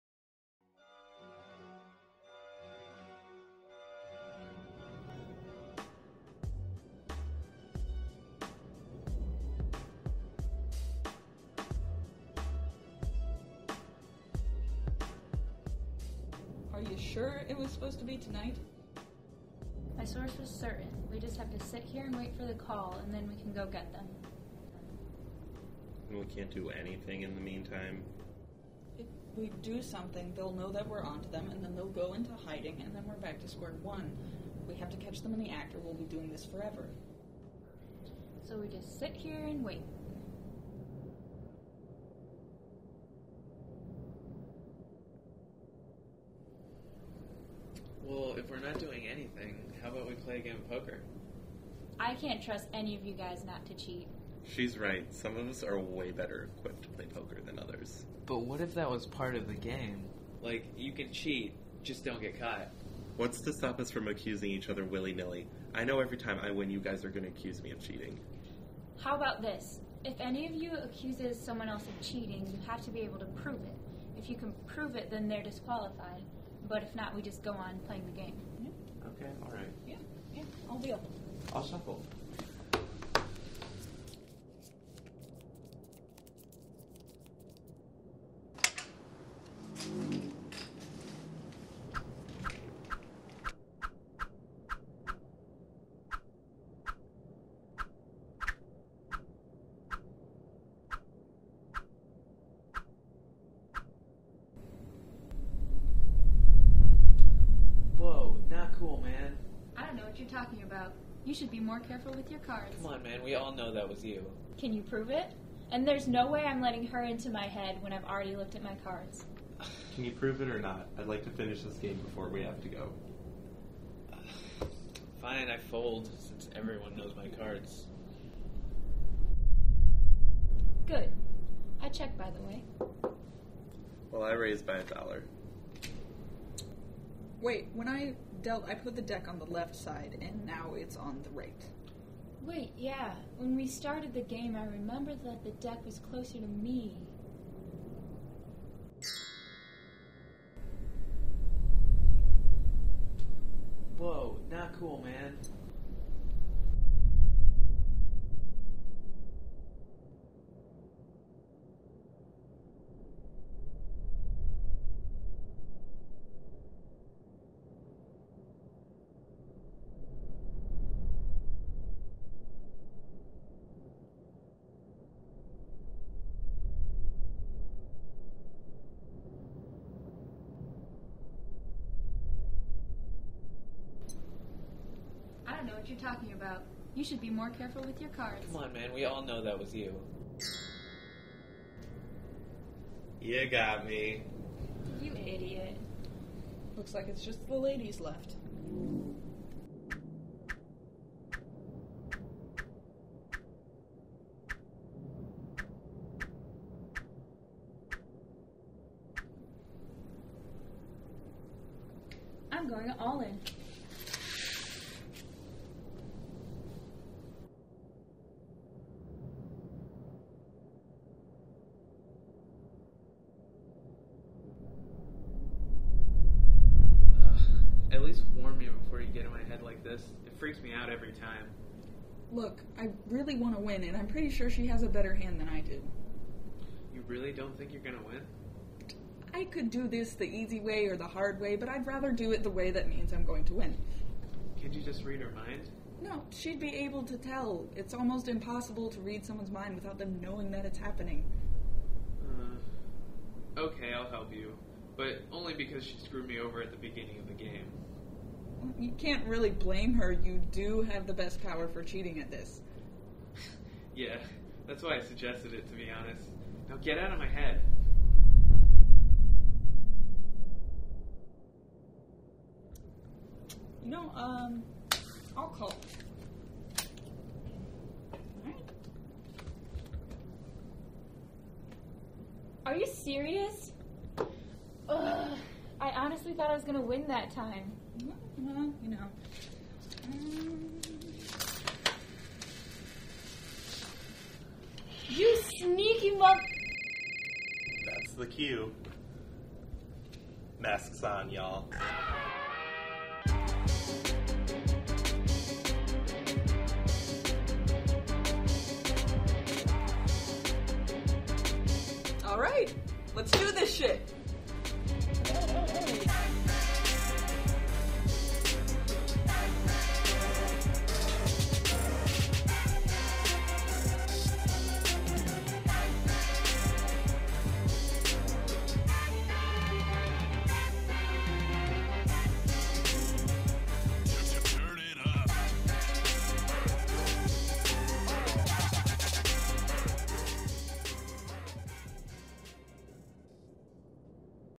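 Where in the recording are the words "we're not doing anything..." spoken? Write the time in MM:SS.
00:48.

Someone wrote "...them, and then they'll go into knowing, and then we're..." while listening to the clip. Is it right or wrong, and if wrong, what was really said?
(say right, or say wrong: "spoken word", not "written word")
wrong: "hiding", not "knowing".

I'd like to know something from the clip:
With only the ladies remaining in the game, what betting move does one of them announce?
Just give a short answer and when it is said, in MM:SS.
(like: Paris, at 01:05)
all in, at 03:32.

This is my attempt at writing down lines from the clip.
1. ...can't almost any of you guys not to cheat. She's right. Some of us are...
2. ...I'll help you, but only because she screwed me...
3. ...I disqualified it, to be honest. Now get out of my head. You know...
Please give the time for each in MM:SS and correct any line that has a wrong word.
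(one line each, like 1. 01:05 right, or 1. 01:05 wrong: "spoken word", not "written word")
1. 00:52 wrong: "trust", not "almost"
2. 04:13 right
3. 04:24 wrong: "suggested", not "disqualified".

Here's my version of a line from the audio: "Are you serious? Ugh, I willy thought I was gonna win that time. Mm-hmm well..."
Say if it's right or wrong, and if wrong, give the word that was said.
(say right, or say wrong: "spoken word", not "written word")
wrong: "honestly", not "willy".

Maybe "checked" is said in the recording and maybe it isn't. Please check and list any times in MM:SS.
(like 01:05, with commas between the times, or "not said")
02:11.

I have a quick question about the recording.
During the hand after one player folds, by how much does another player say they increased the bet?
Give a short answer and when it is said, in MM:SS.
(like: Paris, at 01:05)
a dollar, at 02:14.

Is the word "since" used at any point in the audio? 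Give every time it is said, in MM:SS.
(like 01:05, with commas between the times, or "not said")
02:06.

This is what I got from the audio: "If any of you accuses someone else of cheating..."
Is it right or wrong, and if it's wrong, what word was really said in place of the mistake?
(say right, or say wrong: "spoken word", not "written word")
right.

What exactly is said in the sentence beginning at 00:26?
we can't do anything in the meantime.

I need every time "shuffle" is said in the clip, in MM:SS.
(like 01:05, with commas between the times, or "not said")
01:21.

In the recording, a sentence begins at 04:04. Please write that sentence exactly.
Can't you just read her mind?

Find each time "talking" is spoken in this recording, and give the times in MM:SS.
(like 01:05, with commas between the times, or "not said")
01:50, 03:05.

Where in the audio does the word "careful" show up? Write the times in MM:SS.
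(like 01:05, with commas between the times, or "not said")
01:51, 03:07.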